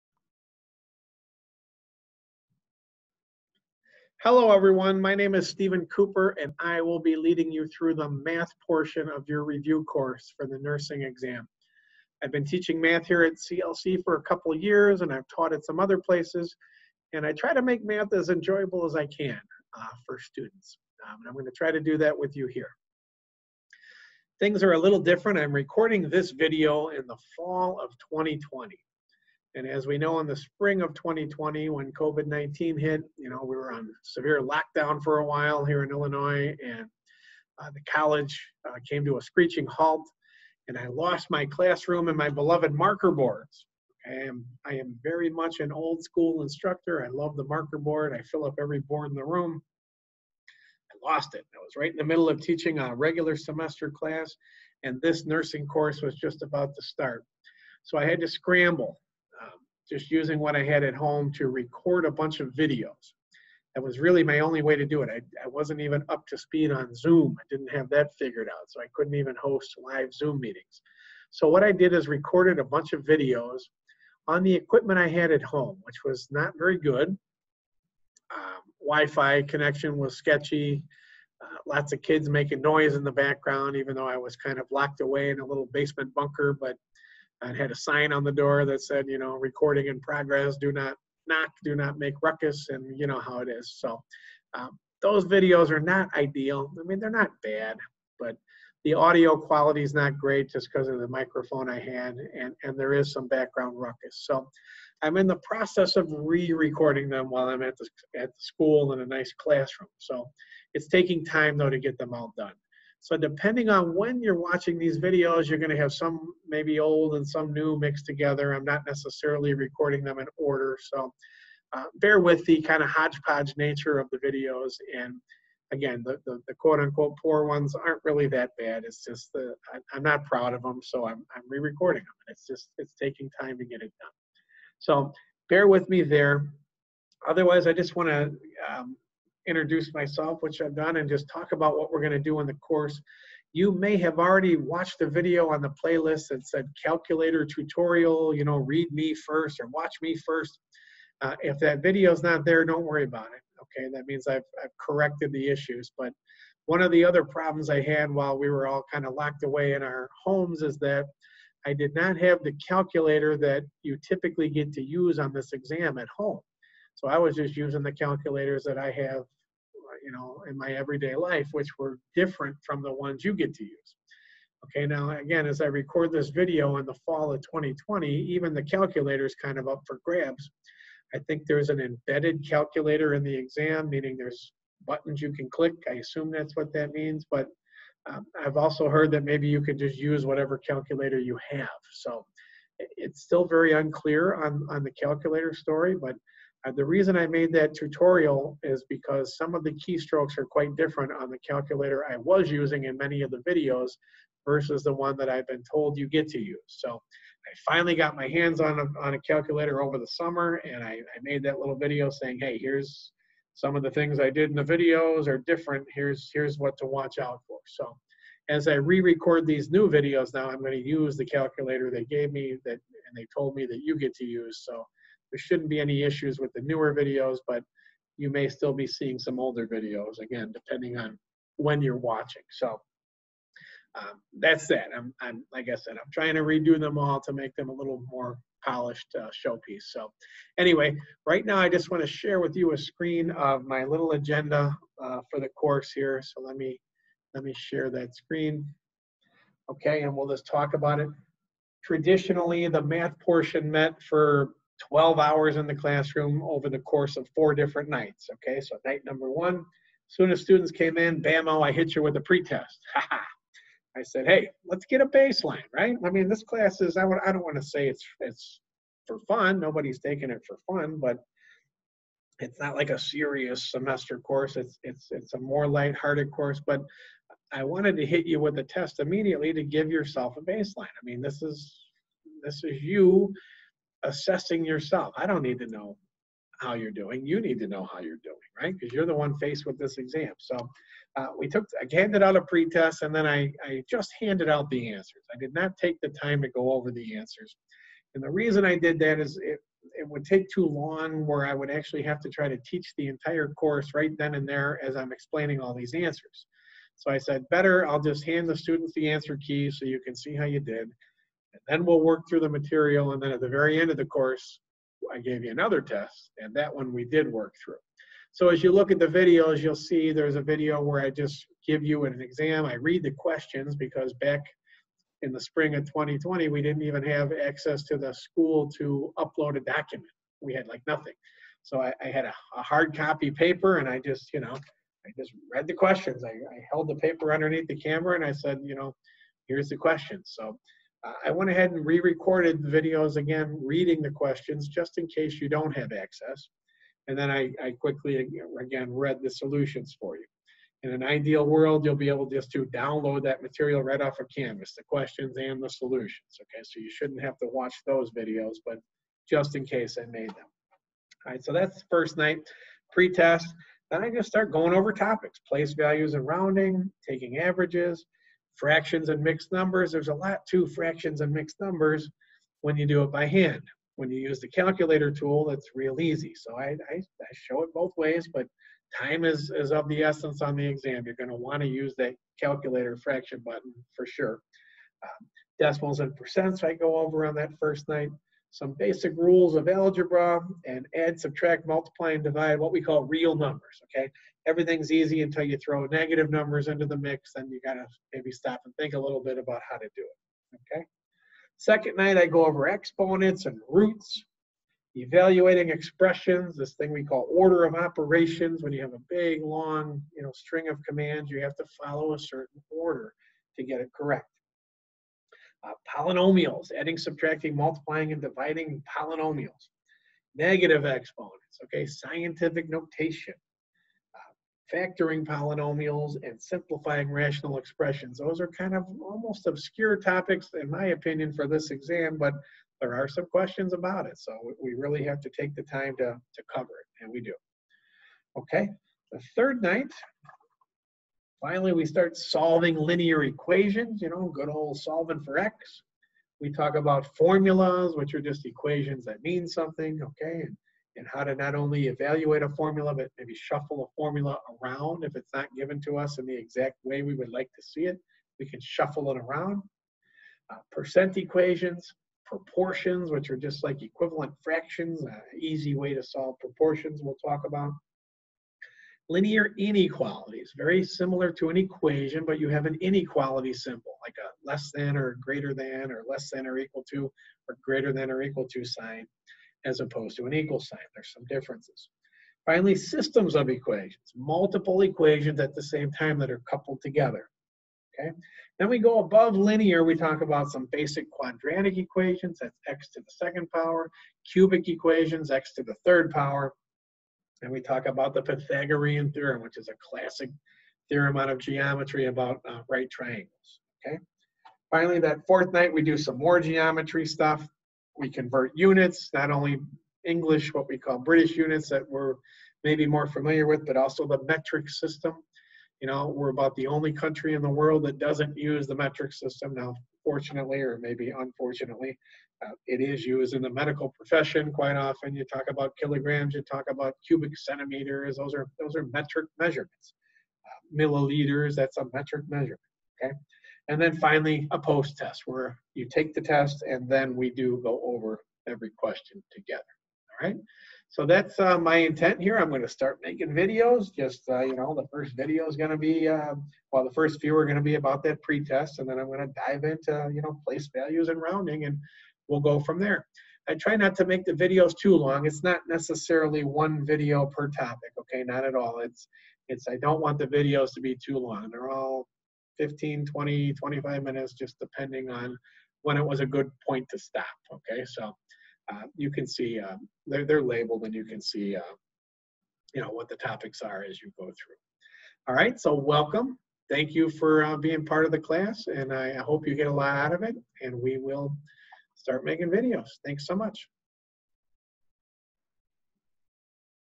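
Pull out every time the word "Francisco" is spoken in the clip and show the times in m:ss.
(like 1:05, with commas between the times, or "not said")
not said.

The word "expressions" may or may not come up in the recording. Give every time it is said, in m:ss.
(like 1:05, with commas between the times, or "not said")
6:45, 7:07.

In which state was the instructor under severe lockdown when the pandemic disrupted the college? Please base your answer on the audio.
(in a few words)
Illinois.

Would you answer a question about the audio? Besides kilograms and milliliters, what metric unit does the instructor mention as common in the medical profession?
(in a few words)
cubic centimeters.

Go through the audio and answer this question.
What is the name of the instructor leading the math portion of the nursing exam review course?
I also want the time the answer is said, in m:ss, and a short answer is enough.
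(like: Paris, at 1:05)
Stephen Cooper, at 0:05.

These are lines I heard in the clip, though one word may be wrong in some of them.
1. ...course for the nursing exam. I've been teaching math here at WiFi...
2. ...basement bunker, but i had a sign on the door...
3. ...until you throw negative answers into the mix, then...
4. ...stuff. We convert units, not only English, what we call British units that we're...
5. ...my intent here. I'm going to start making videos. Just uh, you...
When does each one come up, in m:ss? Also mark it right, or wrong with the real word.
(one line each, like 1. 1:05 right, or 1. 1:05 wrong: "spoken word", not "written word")
1. 0:09 wrong: "CLC", not "WiFi"
2. 1:25 right
3. 6:35 wrong: "numbers", not "answers"
4. 8:27 right
5. 9:01 right.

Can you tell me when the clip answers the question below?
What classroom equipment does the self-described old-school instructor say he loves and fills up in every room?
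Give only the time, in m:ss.
0:42.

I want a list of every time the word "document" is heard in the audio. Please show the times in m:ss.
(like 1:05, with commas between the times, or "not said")
5:29.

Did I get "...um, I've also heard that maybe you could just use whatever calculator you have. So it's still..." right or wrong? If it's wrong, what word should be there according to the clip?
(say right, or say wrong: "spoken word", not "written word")
right.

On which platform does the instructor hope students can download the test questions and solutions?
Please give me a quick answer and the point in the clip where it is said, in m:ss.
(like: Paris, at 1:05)
Canvas, at 5:54.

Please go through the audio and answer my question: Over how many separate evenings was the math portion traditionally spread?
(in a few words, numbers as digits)
4.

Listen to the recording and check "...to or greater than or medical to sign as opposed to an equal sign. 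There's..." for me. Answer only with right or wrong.
wrong.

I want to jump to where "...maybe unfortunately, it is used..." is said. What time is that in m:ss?
8:40.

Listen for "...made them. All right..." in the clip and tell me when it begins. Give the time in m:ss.
6:00.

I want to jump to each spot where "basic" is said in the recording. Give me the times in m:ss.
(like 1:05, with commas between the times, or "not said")
6:28, 8:10.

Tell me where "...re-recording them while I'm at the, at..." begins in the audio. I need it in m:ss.
1:46.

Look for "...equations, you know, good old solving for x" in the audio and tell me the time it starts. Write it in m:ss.
7:23.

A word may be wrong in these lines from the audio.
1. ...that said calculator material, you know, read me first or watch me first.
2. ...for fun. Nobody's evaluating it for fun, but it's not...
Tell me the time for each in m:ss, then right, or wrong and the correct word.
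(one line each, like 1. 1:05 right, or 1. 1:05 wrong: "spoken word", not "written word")
1. 2:26 wrong: "tutorial", not "material"
2. 4:29 wrong: "taking", not "evaluating".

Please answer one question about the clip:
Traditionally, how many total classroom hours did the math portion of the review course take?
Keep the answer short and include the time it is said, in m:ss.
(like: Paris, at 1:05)
12 hours, at 4:14.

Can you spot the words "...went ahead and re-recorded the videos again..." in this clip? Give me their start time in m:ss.
5:41.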